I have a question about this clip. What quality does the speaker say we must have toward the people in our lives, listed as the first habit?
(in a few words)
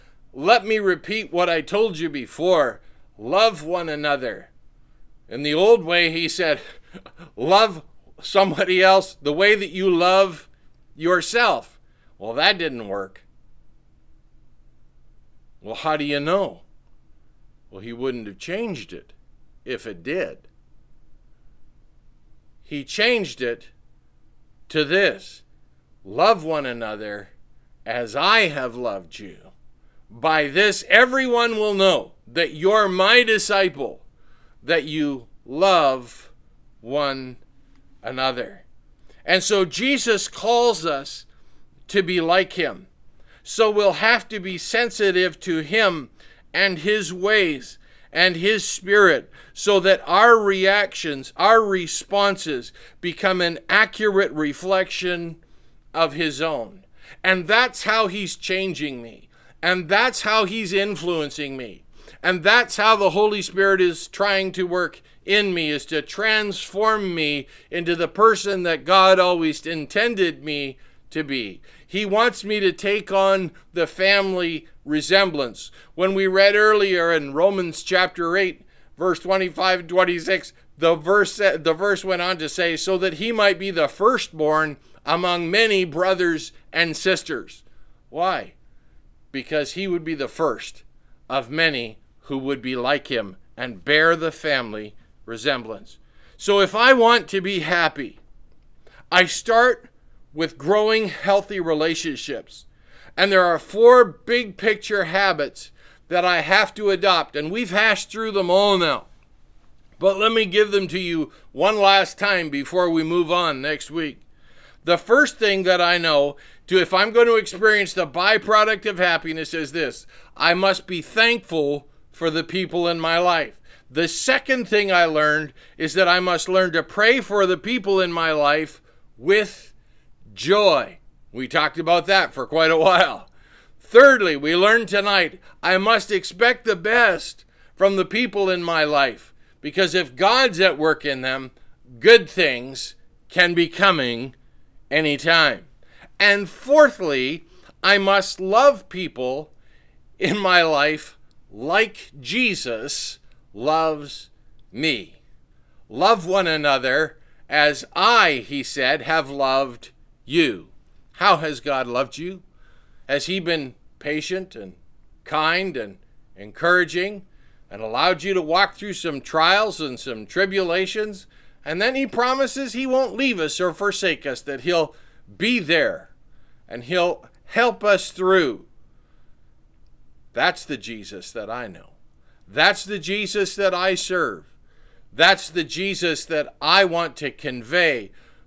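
Thankful.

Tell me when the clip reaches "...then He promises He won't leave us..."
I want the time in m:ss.
2:51.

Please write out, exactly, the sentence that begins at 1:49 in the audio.
But let me give them to you one last time before we move on next week.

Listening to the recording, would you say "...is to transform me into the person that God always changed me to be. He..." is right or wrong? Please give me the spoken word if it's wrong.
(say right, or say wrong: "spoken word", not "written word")
wrong: "intended", not "changed".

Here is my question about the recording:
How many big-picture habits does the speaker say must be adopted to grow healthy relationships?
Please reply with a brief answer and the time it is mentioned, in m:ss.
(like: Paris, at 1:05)
4, at 1:43.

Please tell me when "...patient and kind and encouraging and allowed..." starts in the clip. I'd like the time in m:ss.
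2:43.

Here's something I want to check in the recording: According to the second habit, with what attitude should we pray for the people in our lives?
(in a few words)
Joy.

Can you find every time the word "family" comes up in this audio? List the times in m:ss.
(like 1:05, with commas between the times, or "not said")
1:13, 1:34.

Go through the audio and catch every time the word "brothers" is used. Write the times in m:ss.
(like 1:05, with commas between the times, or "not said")
1:25.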